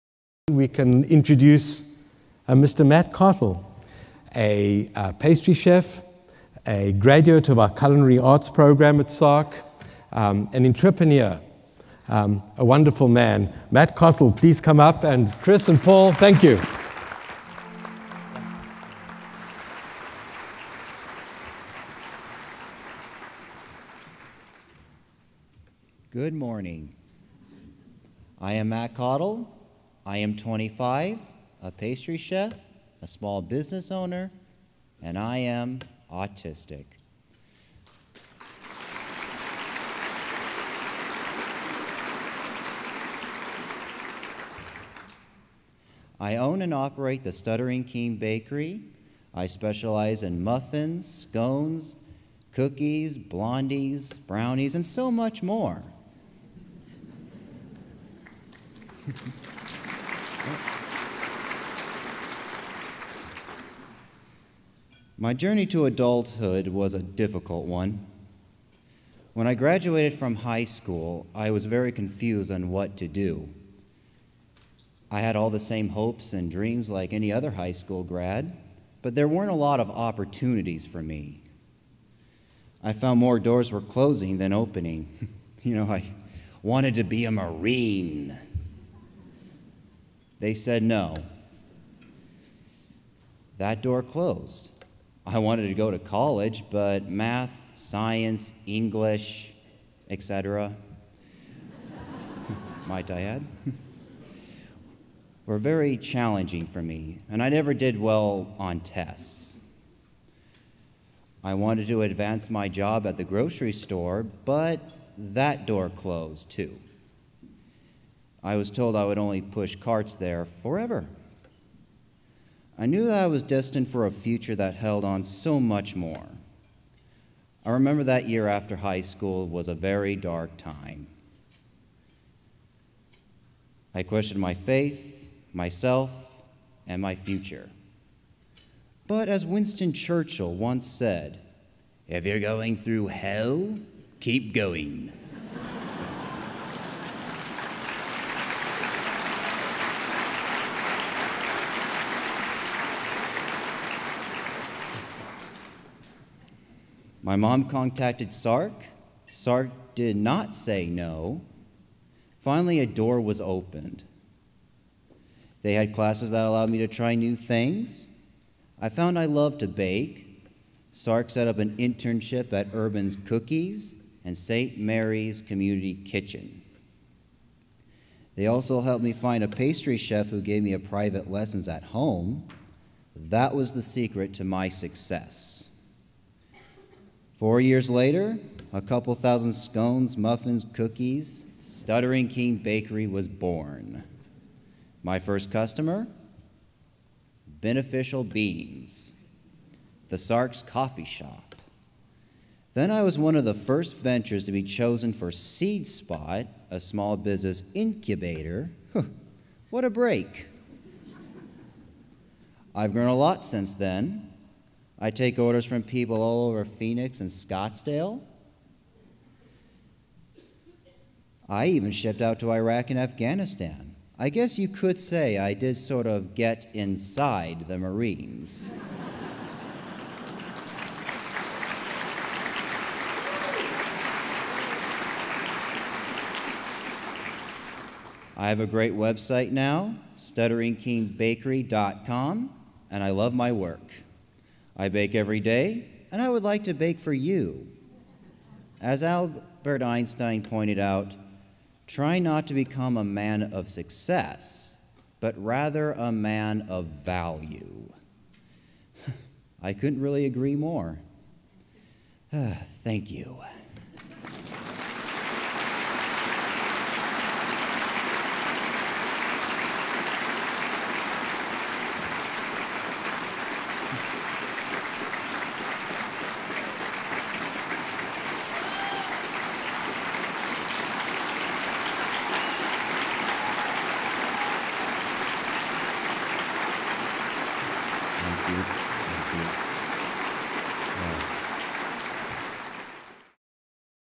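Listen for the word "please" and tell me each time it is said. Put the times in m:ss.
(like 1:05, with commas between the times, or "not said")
0:14.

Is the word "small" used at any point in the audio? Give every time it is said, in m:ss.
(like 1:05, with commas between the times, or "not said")
0:33, 3:26.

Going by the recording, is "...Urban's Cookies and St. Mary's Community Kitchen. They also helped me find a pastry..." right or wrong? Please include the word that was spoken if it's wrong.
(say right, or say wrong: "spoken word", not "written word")
right.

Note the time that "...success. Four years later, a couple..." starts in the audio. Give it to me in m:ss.
3:04.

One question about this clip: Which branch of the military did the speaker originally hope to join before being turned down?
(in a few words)
Marines.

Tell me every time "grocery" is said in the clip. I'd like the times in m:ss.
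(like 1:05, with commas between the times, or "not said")
1:53.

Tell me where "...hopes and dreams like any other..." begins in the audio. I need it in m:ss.
1:15.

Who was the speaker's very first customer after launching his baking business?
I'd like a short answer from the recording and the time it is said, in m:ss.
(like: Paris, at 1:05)
Beneficial Beans, at 3:17.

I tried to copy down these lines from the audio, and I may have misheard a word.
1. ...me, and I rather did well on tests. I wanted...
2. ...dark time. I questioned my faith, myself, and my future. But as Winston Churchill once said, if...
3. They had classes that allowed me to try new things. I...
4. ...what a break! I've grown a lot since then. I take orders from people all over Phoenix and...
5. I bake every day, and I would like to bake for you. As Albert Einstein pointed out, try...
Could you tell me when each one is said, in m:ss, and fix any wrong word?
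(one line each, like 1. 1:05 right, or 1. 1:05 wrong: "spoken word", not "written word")
1. 1:46 wrong: "never", not "rather"
2. 2:10 right
3. 2:45 right
4. 3:29 right
5. 4:04 right.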